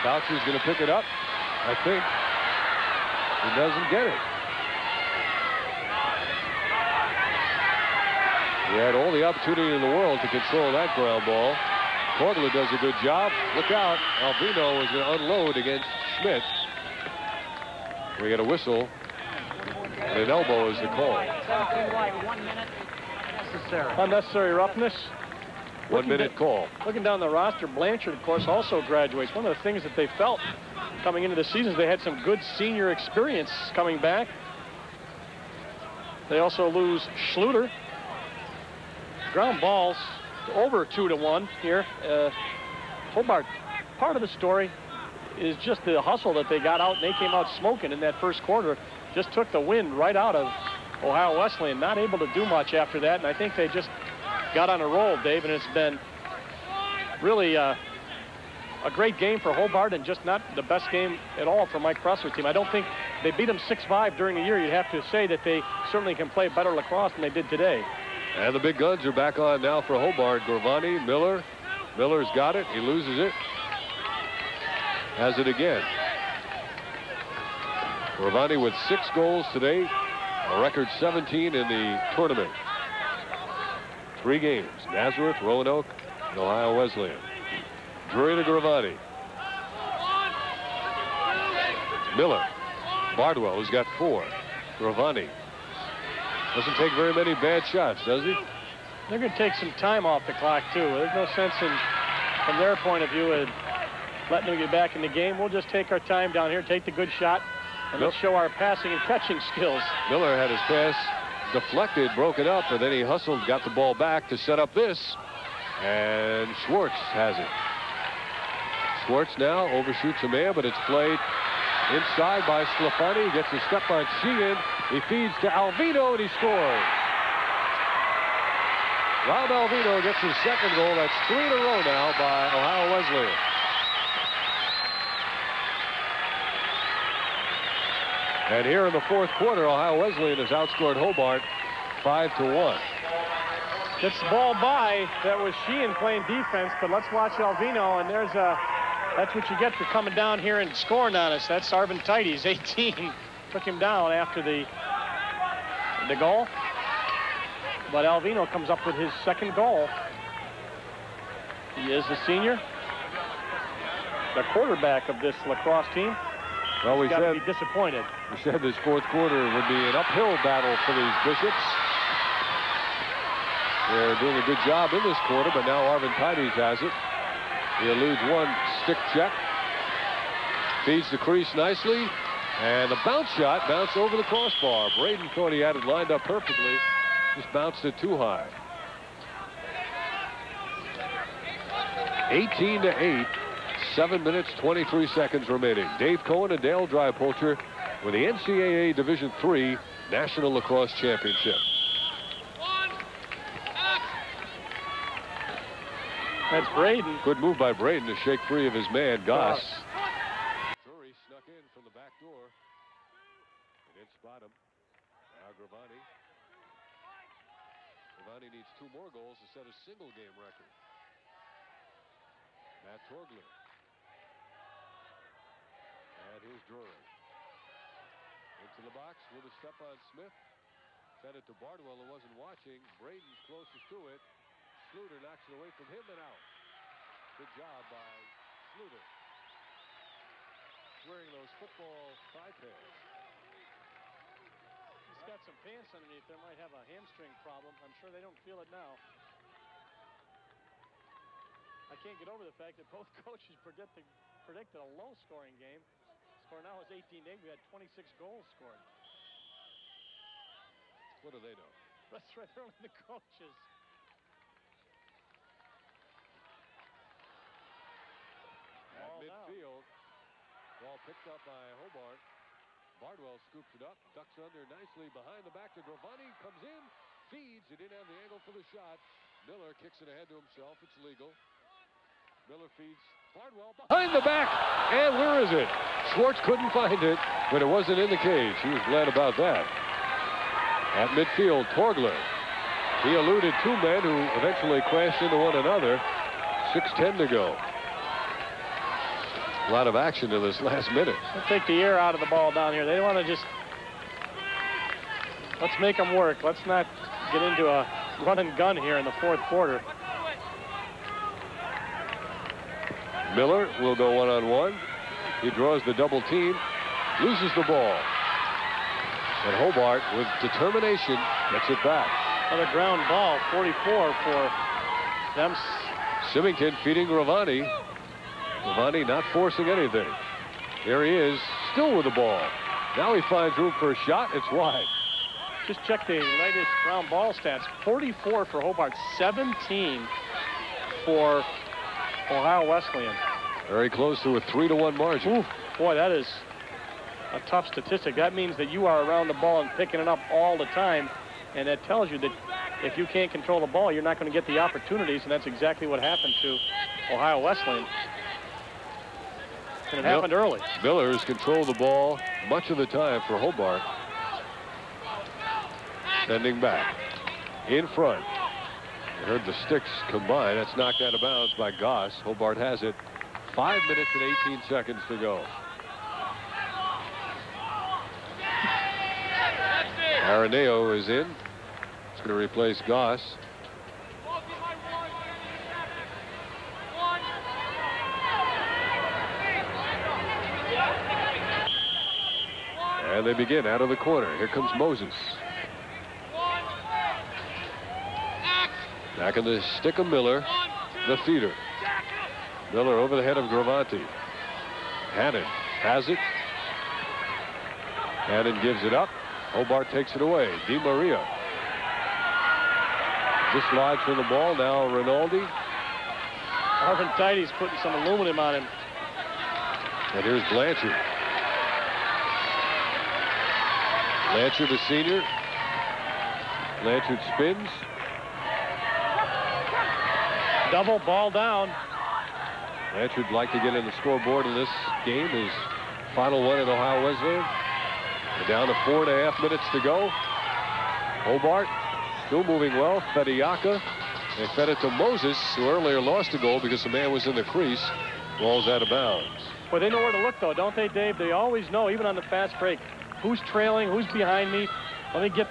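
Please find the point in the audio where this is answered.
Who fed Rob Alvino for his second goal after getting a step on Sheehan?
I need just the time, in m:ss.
2:02.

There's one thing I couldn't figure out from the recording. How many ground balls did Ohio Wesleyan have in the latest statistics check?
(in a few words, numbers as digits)
17.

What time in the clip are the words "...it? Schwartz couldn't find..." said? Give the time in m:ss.
4:45.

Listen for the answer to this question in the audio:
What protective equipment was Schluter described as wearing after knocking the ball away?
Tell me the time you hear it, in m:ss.
4:01.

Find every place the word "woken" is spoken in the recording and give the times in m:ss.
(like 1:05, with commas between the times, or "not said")
not said.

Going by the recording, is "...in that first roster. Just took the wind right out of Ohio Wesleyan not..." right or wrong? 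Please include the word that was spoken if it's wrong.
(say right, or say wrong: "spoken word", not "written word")
wrong: "quarter", not "roster".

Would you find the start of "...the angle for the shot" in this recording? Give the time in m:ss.
4:38.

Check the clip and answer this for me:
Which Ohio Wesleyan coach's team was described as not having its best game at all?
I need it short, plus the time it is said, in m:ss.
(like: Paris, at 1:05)
Mike Pressler, at 1:01.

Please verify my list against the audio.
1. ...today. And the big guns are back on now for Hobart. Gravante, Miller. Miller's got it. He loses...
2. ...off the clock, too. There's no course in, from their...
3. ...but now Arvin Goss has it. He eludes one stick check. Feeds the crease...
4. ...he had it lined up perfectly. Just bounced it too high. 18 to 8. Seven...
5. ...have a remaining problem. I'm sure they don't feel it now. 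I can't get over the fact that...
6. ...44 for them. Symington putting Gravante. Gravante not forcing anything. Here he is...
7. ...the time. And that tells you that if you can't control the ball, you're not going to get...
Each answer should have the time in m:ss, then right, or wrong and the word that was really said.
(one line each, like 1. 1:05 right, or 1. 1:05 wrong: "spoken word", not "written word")
1. 1:07 right
2. 1:40 wrong: "sense", not "course"
3. 2:55 wrong: "Tidies", not "Goss"
4. 3:05 right
5. 4:06 wrong: "hamstring", not "remaining"
6. 5:23 wrong: "feeding", not "putting"
7. 5:50 right.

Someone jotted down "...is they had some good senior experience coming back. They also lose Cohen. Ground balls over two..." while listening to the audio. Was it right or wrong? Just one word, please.
wrong.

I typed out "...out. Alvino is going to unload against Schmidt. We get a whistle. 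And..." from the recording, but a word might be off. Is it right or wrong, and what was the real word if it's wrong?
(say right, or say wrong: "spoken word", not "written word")
right.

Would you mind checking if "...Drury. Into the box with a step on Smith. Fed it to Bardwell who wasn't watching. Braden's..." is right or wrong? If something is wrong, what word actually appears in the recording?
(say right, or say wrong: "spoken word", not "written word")
right.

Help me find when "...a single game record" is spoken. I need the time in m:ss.
3:39.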